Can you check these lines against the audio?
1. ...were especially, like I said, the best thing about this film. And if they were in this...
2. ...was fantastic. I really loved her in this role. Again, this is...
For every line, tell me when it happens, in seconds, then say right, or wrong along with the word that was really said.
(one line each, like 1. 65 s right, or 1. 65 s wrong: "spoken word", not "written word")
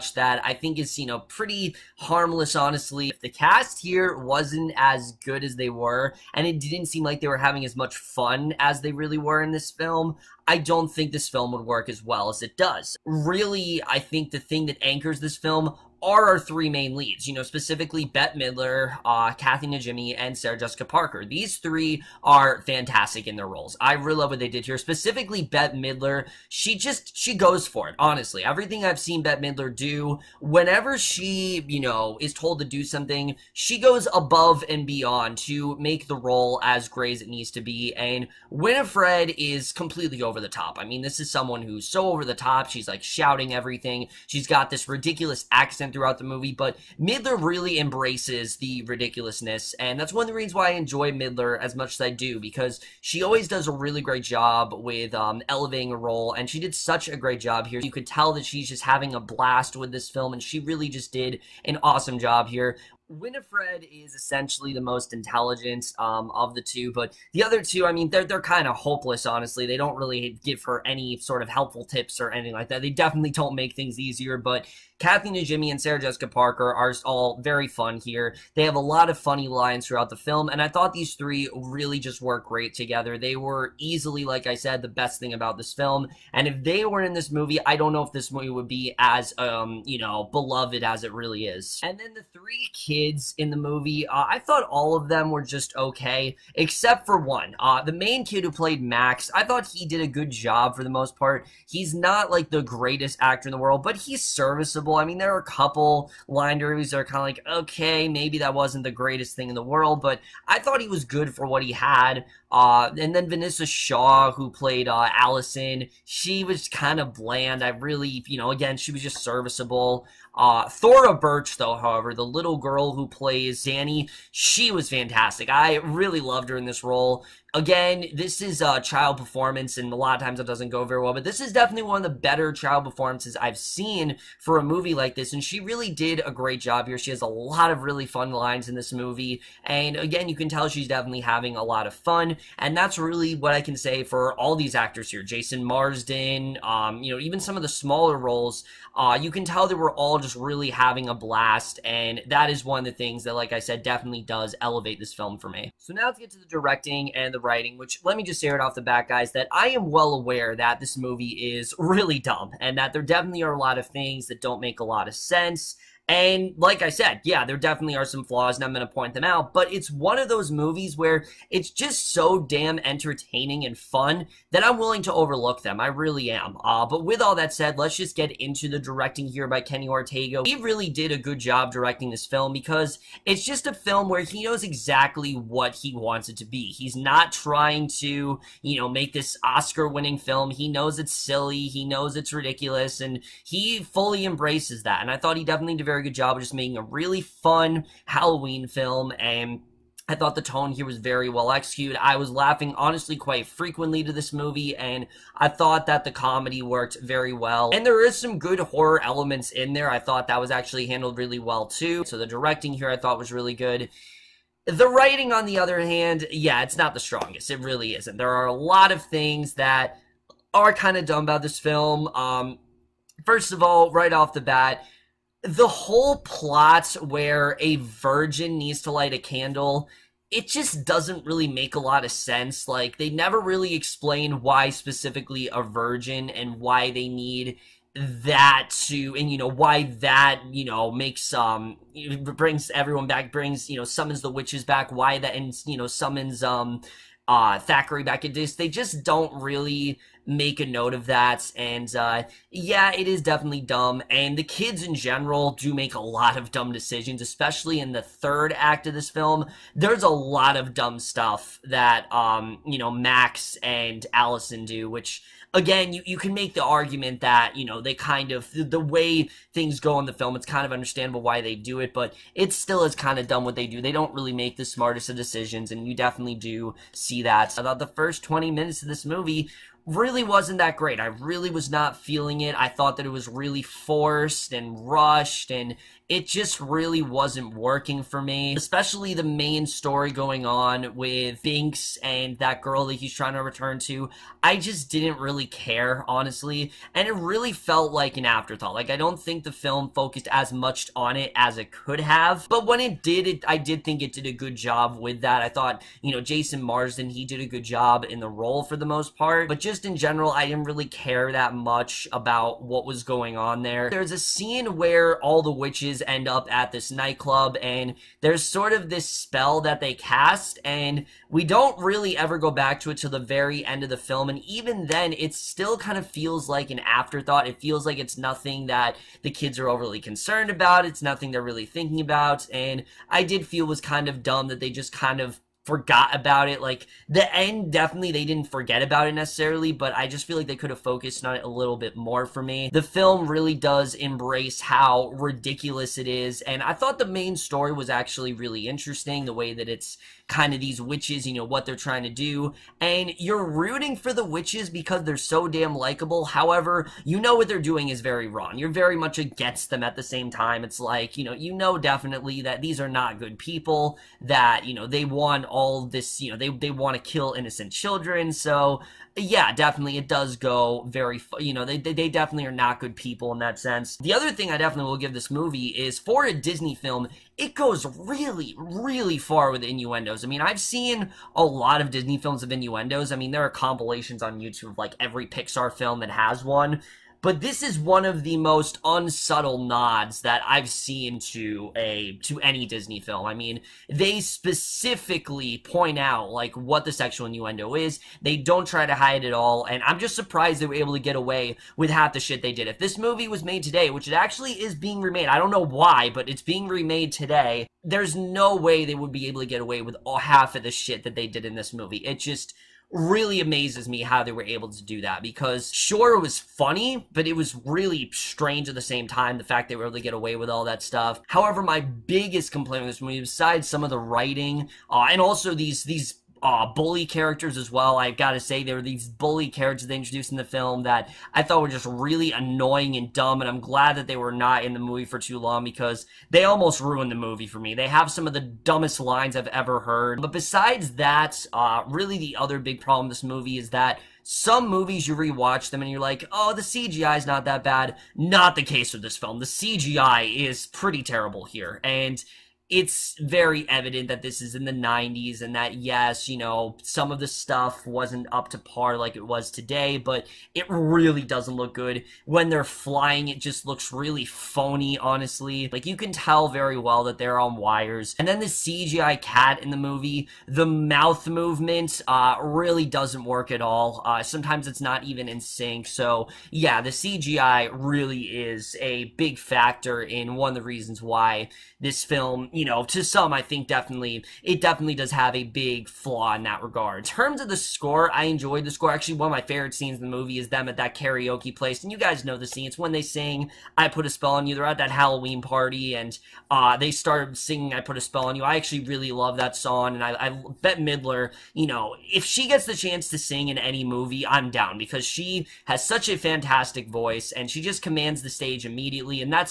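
1. 83 s wrong: "easily", not "especially"
2. 124 s right.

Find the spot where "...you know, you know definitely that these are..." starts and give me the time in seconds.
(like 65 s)
361 s.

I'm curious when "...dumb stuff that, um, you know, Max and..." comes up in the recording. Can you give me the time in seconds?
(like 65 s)
260 s.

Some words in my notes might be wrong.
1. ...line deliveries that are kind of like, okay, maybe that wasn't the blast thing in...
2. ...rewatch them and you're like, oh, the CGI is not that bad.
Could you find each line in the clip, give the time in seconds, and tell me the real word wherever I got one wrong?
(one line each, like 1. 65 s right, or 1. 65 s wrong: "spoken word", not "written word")
1. 106 s wrong: "greatest", not "blast"
2. 445 s right.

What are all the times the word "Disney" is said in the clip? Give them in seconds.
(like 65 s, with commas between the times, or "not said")
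376 s, 381 s, 392 s.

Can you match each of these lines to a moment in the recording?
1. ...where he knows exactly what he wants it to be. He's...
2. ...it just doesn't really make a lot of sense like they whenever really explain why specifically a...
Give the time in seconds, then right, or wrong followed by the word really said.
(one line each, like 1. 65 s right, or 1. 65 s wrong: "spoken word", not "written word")
1. 184 s right
2. 230 s wrong: "never", not "whenever".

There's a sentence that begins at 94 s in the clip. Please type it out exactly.
Uh, I thought all of them were just okay, except for one.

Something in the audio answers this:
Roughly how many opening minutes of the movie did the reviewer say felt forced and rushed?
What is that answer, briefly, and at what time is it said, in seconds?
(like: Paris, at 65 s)
20, at 278 s.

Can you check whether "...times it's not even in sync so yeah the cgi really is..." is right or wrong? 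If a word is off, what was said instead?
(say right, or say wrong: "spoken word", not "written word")
wrong: "sometimes", not "times".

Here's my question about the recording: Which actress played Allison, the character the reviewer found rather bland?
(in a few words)
Vanessa Shaw.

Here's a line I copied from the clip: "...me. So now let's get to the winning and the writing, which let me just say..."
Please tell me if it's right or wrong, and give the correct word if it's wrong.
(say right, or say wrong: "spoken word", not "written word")
wrong: "directing", not "winning".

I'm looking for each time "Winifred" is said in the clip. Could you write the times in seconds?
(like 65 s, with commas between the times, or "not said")
38 s, 63 s.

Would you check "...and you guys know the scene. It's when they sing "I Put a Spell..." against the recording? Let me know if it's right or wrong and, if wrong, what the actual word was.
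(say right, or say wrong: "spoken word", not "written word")
right.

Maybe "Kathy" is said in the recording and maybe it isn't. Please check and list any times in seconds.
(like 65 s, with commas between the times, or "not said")
19 s, 74 s.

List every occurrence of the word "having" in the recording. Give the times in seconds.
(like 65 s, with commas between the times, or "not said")
7 s, 58 s, 141 s, 150 s.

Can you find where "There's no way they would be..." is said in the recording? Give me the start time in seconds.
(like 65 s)
407 s.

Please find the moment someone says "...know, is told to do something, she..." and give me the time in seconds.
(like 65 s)
31 s.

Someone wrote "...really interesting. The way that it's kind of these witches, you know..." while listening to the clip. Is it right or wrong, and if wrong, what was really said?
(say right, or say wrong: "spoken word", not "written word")
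right.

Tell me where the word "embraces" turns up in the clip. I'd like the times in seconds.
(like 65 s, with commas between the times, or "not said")
47 s, 194 s, 343 s.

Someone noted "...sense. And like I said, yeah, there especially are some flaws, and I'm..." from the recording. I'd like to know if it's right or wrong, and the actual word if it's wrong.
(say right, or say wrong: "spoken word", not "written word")
wrong: "definitely", not "especially".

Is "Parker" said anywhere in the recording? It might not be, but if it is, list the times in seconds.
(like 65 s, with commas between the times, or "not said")
20 s, 76 s.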